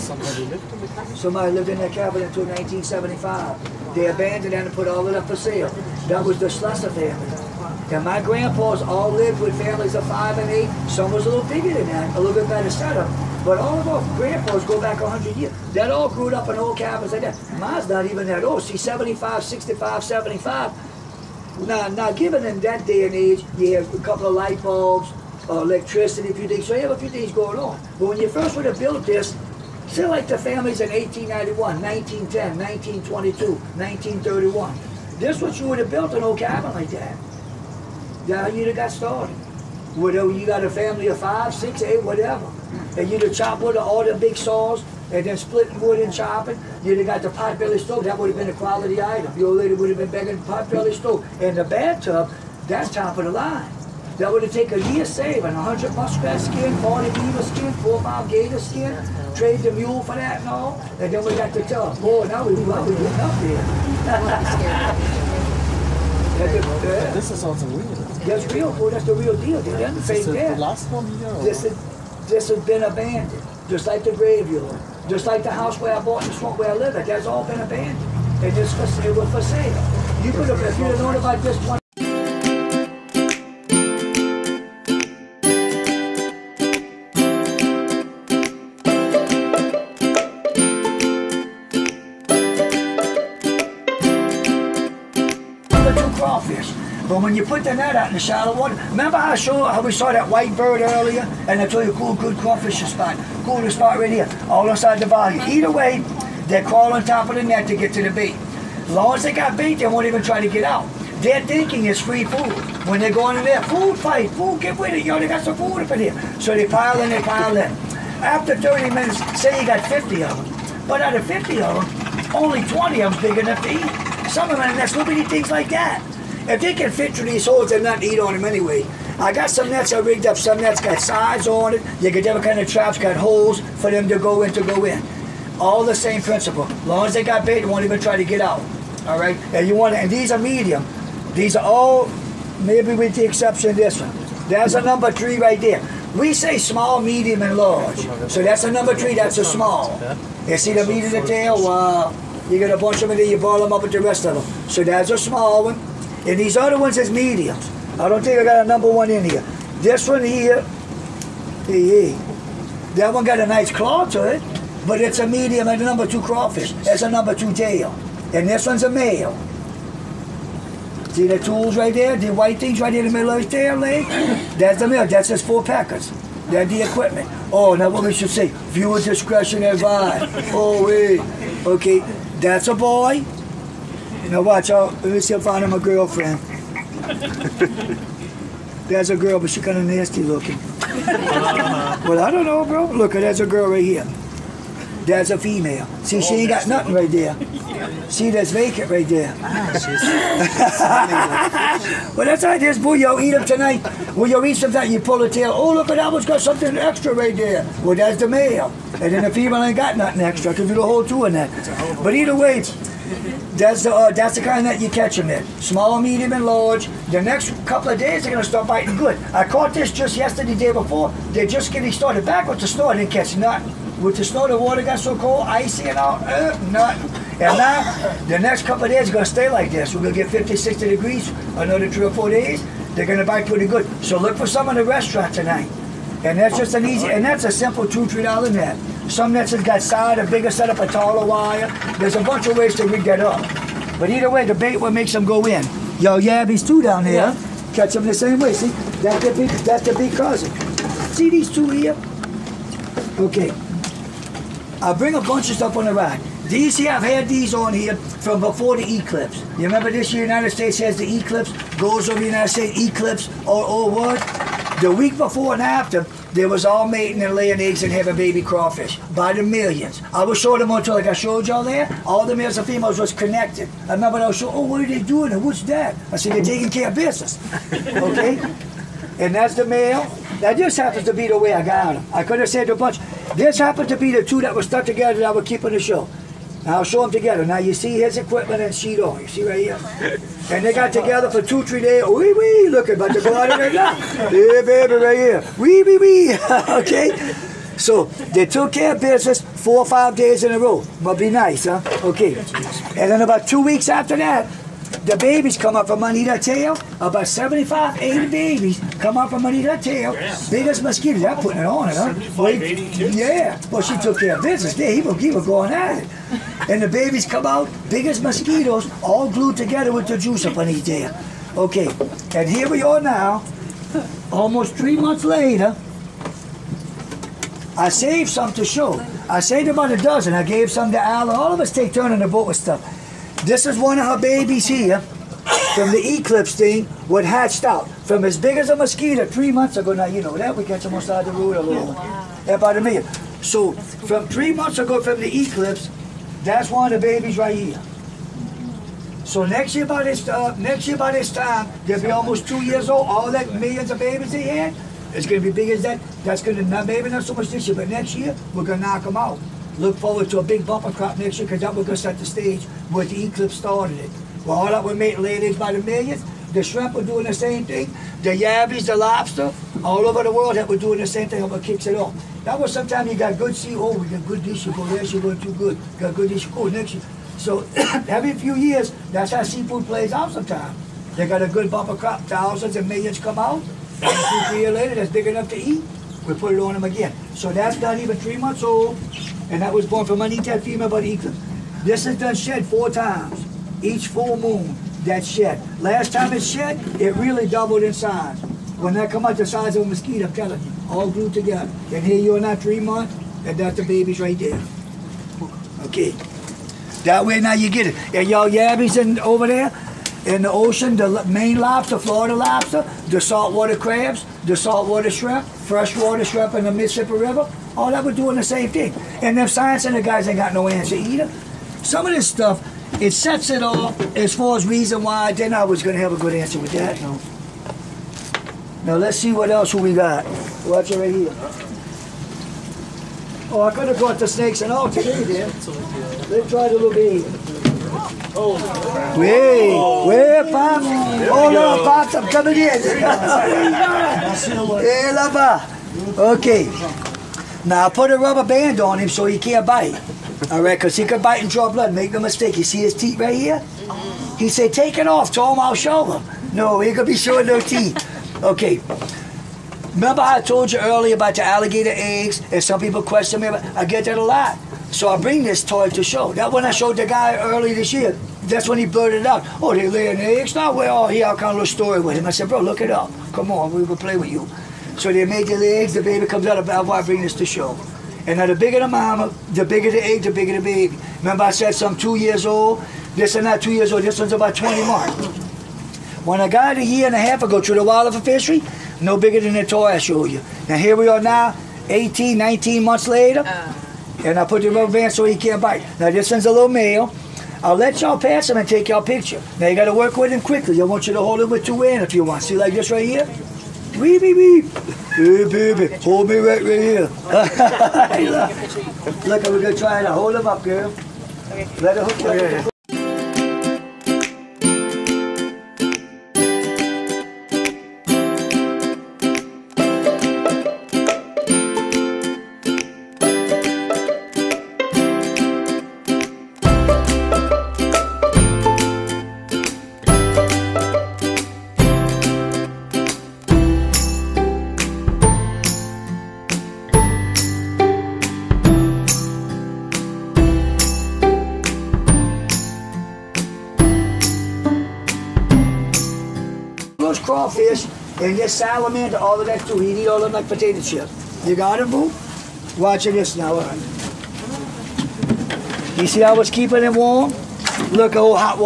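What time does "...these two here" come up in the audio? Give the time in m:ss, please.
4:11.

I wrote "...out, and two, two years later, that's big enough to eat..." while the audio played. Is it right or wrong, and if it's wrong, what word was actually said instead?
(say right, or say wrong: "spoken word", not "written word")
wrong: "three", not "two".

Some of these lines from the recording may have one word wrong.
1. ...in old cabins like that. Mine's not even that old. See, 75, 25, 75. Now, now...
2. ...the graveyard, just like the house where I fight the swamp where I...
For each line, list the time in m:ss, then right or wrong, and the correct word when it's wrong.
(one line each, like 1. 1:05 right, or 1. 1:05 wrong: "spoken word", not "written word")
1. 0:16 wrong: "65", not "25"
2. 1:14 wrong: "bought", not "fight".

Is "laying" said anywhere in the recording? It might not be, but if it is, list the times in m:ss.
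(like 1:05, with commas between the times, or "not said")
4:27, 7:49.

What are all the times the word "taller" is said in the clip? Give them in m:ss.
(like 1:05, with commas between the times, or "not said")
4:00.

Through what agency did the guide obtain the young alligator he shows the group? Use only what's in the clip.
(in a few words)
wildlife fishery.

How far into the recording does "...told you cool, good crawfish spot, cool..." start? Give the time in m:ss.
1:41.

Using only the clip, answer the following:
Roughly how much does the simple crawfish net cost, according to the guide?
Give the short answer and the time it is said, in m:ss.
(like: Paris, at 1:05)
2 to 3 dollars, at 3:57.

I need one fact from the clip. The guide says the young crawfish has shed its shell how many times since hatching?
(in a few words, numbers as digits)
4.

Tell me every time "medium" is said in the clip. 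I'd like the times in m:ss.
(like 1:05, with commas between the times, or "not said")
2:20, 2:27, 2:37, 2:45, 3:36.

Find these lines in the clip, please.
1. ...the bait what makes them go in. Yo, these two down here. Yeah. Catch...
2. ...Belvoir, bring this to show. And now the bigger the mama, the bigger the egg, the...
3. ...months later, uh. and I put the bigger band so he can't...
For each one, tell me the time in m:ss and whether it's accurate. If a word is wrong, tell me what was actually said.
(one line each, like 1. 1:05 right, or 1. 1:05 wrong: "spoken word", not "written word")
1. 4:04 right
2. 7:56 right
3. 8:12 wrong: "rubber", not "bigger".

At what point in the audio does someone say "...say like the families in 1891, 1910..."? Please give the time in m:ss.
0:29.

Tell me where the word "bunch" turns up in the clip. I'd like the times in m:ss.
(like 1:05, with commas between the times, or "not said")
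2:32, 4:02, 4:15, 4:42.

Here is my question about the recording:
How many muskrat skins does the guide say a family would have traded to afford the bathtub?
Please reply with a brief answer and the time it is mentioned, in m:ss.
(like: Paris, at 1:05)
100, at 0:55.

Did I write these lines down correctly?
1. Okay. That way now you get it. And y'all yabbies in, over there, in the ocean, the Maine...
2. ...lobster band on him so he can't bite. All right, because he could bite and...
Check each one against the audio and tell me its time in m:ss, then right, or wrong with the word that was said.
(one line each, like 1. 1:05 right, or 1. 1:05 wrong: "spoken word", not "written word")
1. 6:45 right
2. 7:28 wrong: "rubber", not "lobster".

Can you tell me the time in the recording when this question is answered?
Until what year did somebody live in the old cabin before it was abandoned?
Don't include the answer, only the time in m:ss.
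0:02.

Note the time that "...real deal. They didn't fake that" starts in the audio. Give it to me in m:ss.
1:09.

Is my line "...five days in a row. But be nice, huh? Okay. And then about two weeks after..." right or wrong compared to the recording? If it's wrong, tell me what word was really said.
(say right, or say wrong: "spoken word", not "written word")
right.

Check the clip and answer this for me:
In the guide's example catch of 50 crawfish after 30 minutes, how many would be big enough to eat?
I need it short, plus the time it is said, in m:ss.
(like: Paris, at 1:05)
20, at 2:02.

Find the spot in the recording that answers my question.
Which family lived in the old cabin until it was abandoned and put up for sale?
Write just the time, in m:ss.
0:06.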